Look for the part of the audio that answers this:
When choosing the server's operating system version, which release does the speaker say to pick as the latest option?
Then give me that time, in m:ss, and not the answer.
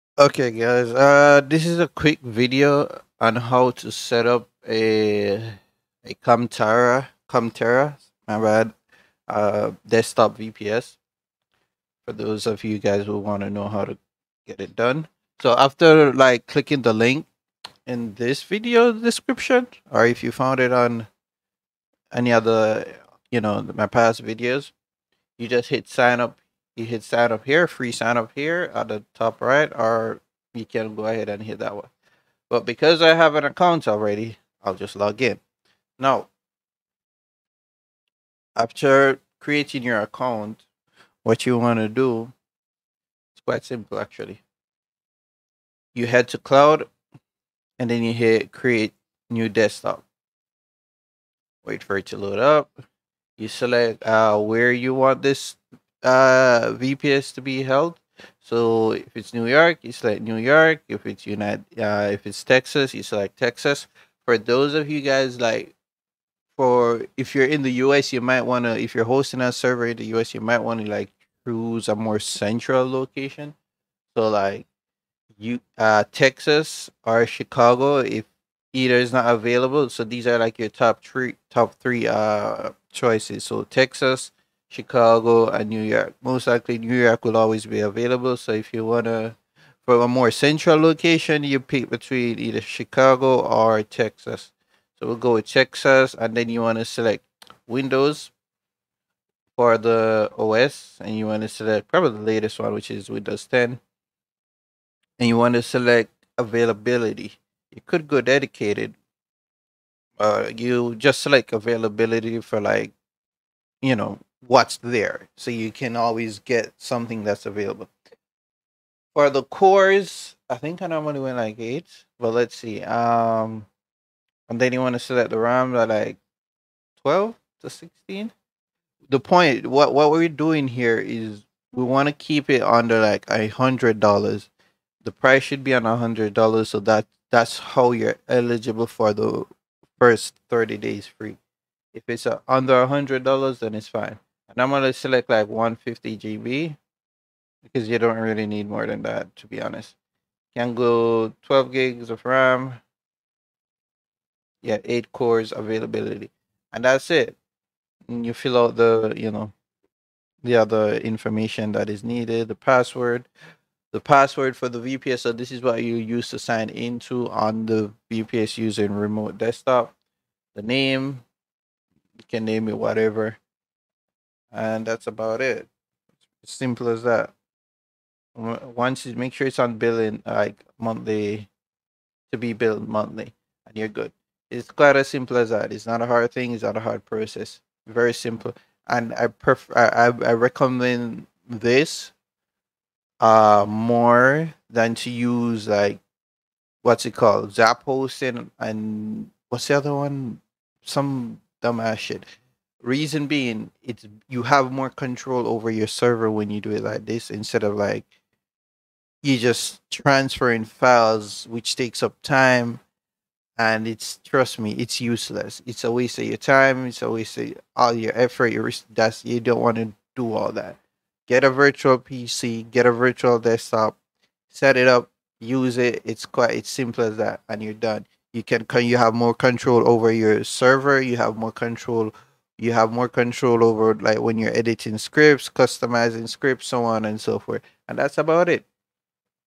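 1:43.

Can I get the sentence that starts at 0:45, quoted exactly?
You head to cloud and then you hit create new desktop.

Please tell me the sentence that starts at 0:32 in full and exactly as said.
But because I have an account already, I'll just log in.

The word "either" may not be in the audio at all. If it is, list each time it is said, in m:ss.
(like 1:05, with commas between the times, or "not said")
1:18, 1:32.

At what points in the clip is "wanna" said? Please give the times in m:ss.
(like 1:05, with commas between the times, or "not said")
1:28, 1:36, 1:41, 1:45.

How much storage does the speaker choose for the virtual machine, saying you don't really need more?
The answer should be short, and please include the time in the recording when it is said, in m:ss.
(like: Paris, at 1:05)
150 GB, at 2:25.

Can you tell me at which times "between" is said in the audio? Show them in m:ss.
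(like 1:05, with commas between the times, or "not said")
1:31.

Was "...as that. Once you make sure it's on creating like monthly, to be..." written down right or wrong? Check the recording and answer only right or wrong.
wrong.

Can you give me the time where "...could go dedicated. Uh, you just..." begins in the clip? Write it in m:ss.
1:47.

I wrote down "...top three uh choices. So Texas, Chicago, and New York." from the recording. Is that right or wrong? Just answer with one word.
right.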